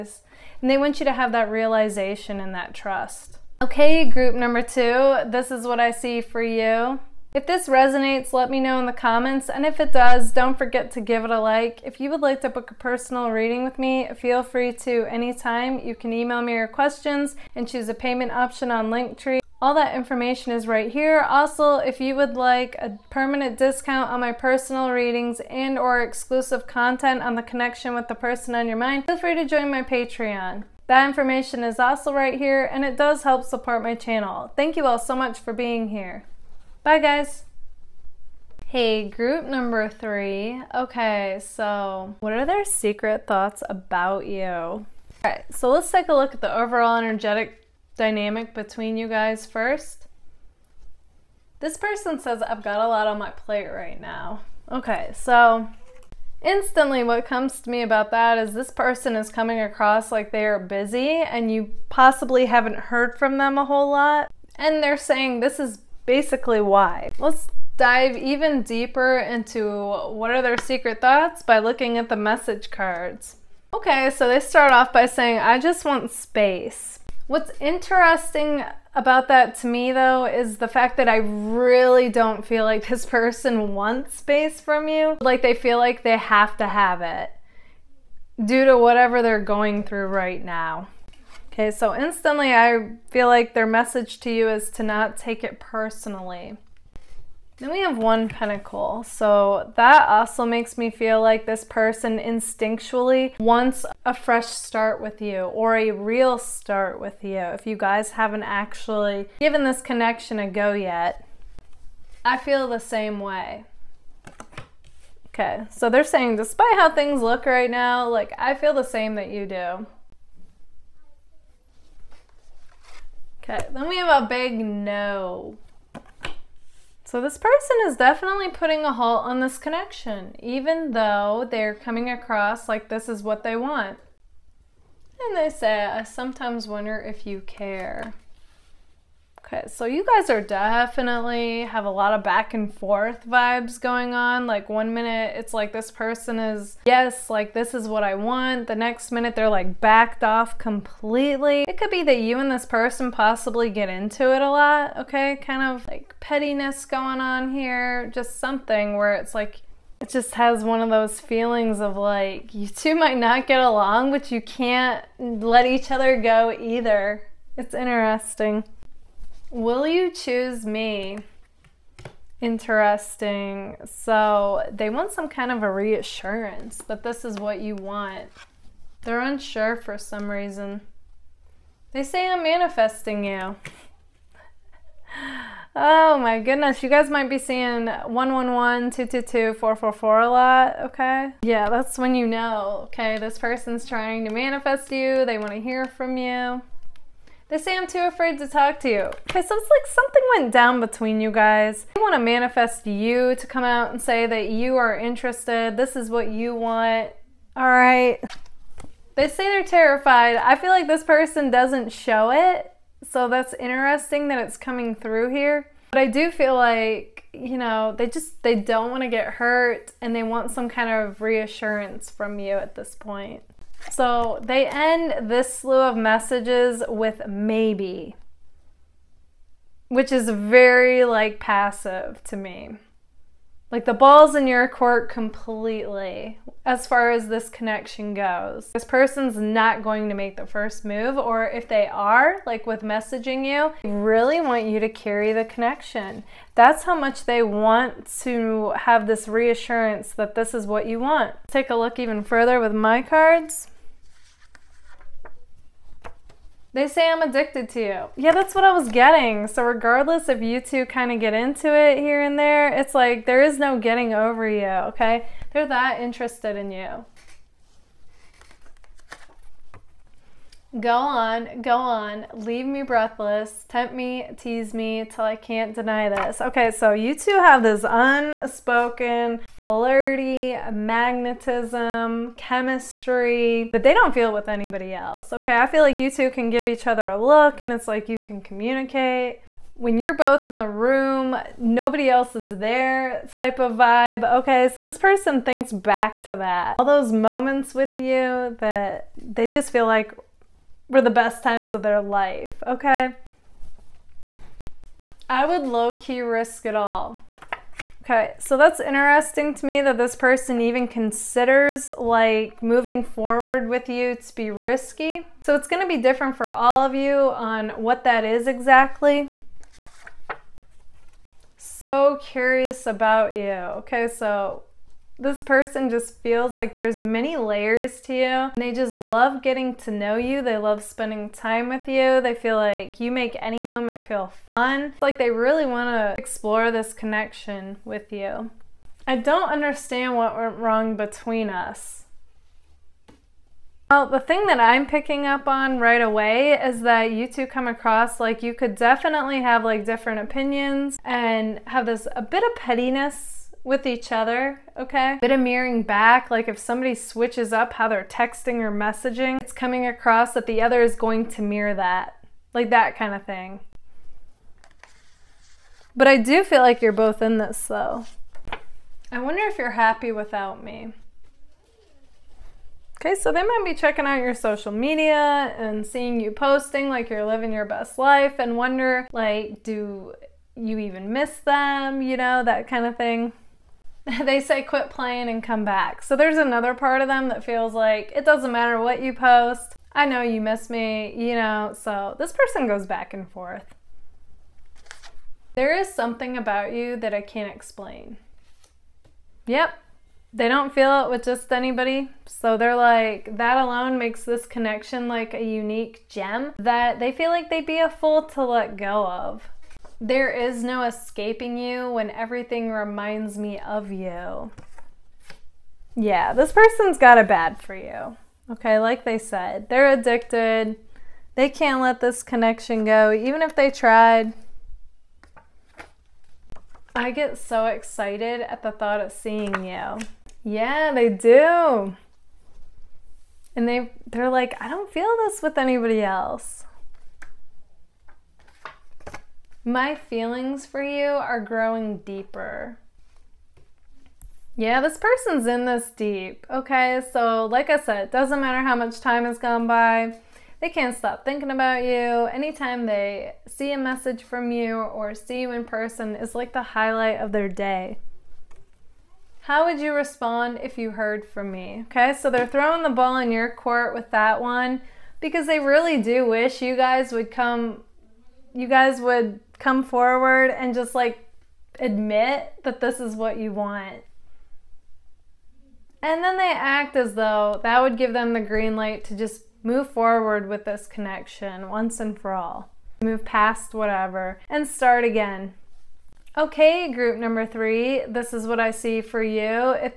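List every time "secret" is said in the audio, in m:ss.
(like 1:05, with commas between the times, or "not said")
0:42, 1:10.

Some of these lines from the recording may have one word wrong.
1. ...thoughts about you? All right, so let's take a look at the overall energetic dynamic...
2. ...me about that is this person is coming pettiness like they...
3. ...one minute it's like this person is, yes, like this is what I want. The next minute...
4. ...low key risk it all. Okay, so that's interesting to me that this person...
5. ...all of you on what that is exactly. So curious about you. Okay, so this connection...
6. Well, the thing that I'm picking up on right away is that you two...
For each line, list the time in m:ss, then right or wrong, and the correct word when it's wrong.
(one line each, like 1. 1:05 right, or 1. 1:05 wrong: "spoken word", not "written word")
1. 0:43 right
2. 0:57 wrong: "across", not "pettiness"
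3. 2:24 right
4. 5:05 right
5. 5:16 wrong: "person", not "connection"
6. 5:43 right.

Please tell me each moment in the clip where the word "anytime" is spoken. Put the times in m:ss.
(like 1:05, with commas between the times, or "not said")
0:15, 7:32.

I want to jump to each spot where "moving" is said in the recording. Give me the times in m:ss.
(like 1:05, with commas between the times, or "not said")
5:12.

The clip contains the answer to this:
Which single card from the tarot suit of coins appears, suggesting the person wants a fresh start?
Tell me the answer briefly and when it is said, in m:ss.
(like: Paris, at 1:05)
one pentacle, at 1:37.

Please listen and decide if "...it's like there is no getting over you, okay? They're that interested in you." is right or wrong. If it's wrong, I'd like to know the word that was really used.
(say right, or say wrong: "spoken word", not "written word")
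right.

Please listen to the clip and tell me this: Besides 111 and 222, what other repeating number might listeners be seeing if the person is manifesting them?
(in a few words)
444.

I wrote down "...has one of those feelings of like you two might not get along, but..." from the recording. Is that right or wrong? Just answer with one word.
right.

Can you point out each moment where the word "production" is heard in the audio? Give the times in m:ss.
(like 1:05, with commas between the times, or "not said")
not said.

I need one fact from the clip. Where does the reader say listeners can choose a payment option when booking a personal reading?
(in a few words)
Linktree.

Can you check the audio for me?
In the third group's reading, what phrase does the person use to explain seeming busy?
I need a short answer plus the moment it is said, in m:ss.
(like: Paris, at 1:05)
a lot on my plate, at 0:52.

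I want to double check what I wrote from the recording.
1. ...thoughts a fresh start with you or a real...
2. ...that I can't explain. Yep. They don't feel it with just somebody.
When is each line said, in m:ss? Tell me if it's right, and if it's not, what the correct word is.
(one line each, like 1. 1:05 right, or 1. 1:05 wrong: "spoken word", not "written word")
1. 1:43 wrong: "wants", not "thoughts"
2. 6:36 wrong: "anybody", not "somebody".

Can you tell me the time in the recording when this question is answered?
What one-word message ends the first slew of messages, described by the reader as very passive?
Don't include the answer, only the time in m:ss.
3:47.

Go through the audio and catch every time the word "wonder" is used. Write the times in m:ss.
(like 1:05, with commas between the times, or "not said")
2:16, 6:09, 6:18.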